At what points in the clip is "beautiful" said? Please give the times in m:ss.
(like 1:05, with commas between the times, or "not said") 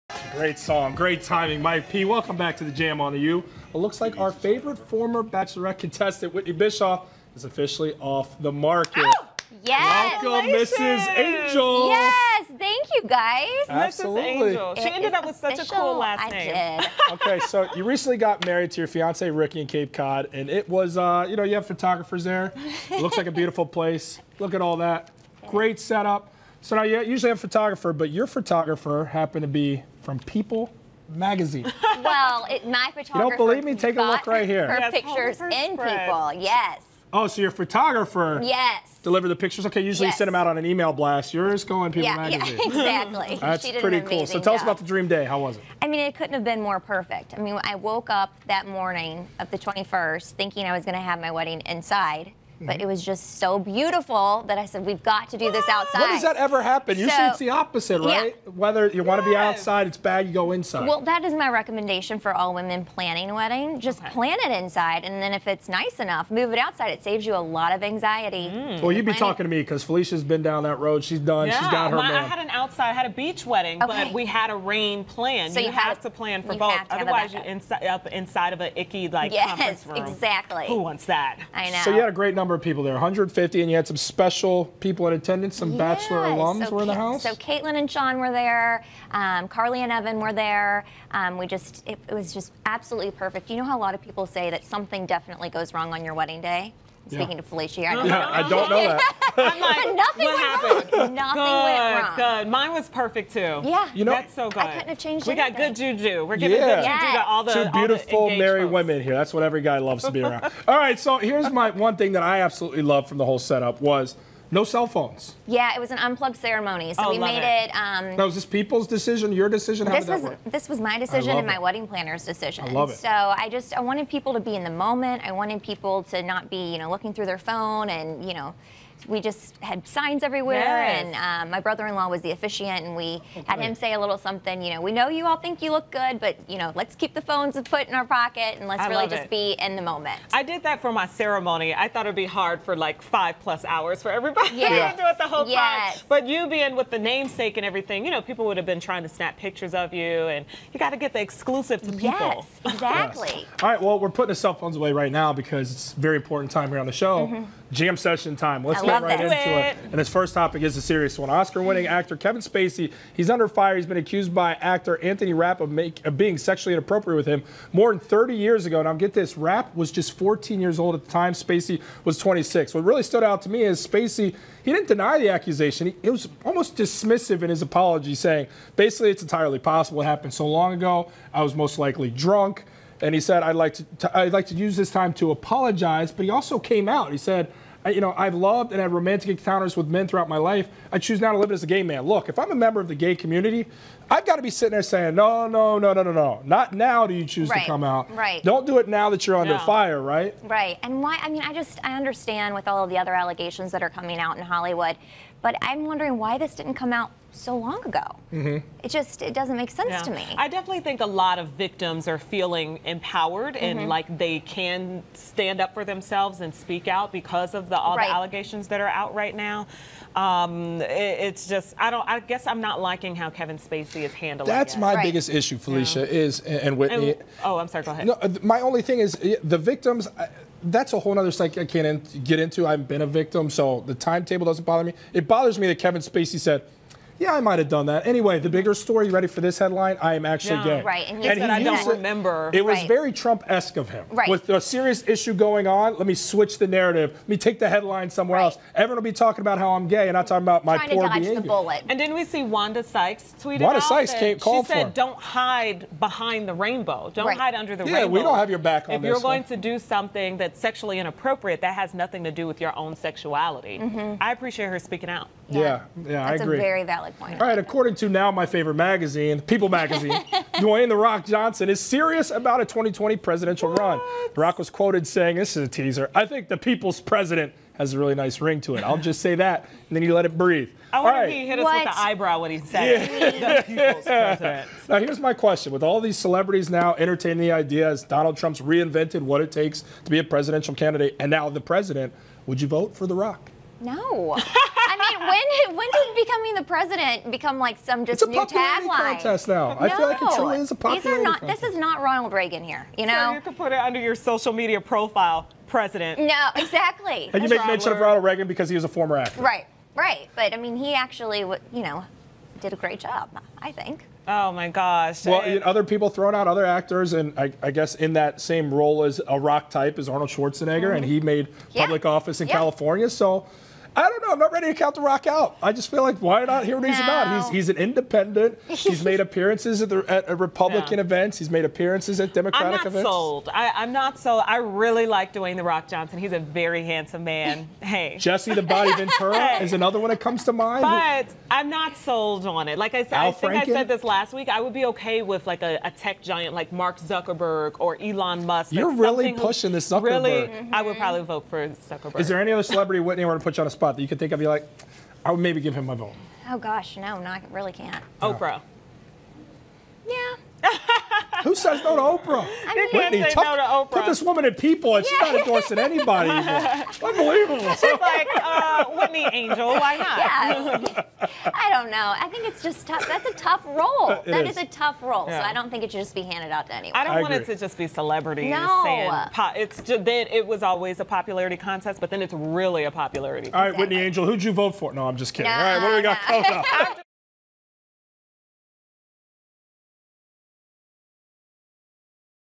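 0:23, 0:53, 1:47.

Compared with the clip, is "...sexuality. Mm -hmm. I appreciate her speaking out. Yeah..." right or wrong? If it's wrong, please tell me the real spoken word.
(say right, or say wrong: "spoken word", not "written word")
right.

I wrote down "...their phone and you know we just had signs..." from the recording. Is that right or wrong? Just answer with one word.
right.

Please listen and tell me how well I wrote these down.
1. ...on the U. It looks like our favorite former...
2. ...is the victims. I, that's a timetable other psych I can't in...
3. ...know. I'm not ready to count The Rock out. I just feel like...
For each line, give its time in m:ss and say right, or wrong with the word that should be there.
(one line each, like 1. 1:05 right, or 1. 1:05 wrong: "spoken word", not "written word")
1. 0:03 right
2. 3:49 wrong: "whole", not "timetable"
3. 5:24 right.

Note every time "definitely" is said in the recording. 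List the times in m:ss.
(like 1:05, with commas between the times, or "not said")
1:35, 3:30.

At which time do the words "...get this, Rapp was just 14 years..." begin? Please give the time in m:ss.
2:48.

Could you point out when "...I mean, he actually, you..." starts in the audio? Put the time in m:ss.
5:10.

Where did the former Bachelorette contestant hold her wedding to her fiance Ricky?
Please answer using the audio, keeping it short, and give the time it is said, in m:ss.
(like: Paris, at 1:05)
Cape Cod, at 0:19.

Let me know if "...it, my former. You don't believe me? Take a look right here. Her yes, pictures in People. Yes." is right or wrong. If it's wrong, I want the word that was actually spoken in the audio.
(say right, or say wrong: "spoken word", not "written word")
wrong: "photographer", not "former".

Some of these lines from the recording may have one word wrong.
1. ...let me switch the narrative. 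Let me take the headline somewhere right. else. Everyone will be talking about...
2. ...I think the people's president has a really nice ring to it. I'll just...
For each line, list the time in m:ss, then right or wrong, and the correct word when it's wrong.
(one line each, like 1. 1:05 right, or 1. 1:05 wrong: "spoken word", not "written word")
1. 4:05 right
2. 4:36 right.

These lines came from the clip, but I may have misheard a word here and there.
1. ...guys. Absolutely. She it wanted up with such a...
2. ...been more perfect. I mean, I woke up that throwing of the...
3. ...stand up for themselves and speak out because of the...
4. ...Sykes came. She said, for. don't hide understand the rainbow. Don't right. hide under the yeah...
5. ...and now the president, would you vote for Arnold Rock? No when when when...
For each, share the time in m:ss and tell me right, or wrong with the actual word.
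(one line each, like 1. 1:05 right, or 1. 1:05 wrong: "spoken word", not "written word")
1. 0:13 wrong: "ended", not "wanted"
2. 0:46 wrong: "morning", not "throwing"
3. 3:35 right
4. 4:13 wrong: "behind", not "understand"
5. 4:51 wrong: "The", not "Arnold".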